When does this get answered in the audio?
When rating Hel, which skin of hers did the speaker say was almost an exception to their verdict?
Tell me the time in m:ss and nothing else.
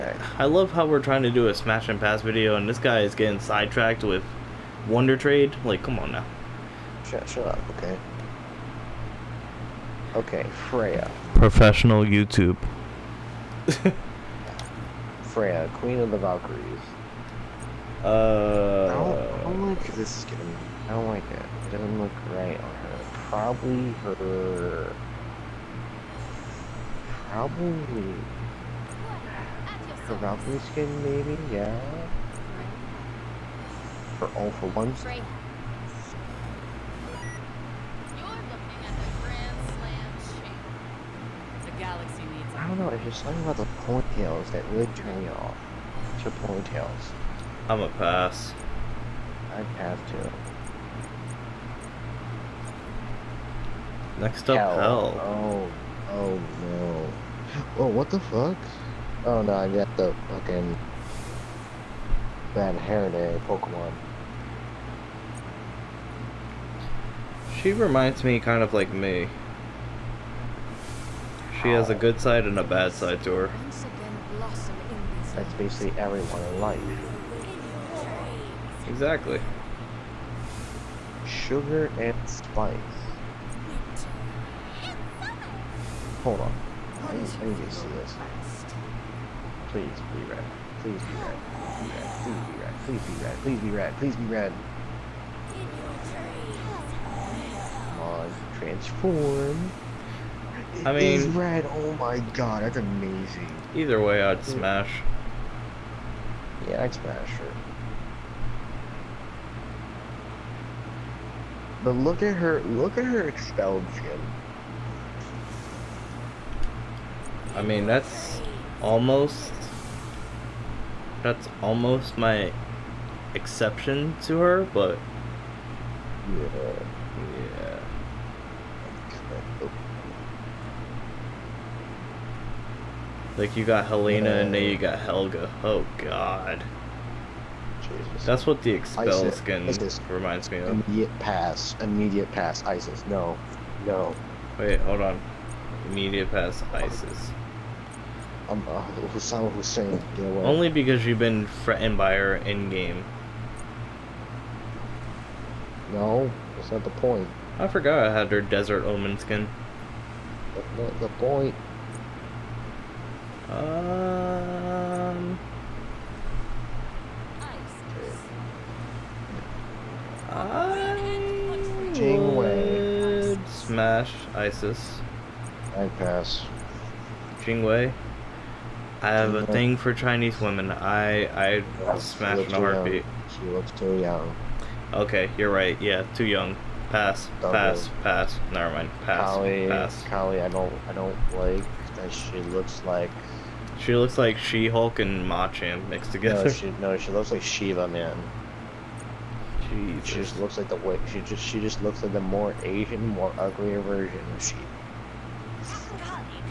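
1:53.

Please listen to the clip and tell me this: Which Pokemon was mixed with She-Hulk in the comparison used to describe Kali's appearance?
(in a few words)
Machamp.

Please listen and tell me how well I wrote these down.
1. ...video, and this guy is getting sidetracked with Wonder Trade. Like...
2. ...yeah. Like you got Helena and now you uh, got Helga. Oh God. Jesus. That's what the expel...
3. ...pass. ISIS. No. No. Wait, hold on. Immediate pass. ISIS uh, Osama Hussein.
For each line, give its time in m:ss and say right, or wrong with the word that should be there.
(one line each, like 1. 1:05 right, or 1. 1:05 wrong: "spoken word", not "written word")
1. 0:02 right
2. 2:06 right
3. 2:22 right.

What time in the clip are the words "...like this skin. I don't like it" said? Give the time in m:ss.
0:19.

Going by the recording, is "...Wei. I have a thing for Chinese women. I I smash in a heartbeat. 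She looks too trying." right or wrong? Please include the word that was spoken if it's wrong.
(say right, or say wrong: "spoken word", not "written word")
wrong: "young", not "trying".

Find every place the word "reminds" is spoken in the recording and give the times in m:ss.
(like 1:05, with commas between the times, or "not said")
1:07, 2:20.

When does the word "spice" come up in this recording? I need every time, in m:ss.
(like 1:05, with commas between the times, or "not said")
1:22.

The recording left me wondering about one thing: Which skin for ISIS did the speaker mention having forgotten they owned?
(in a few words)
Desert omen.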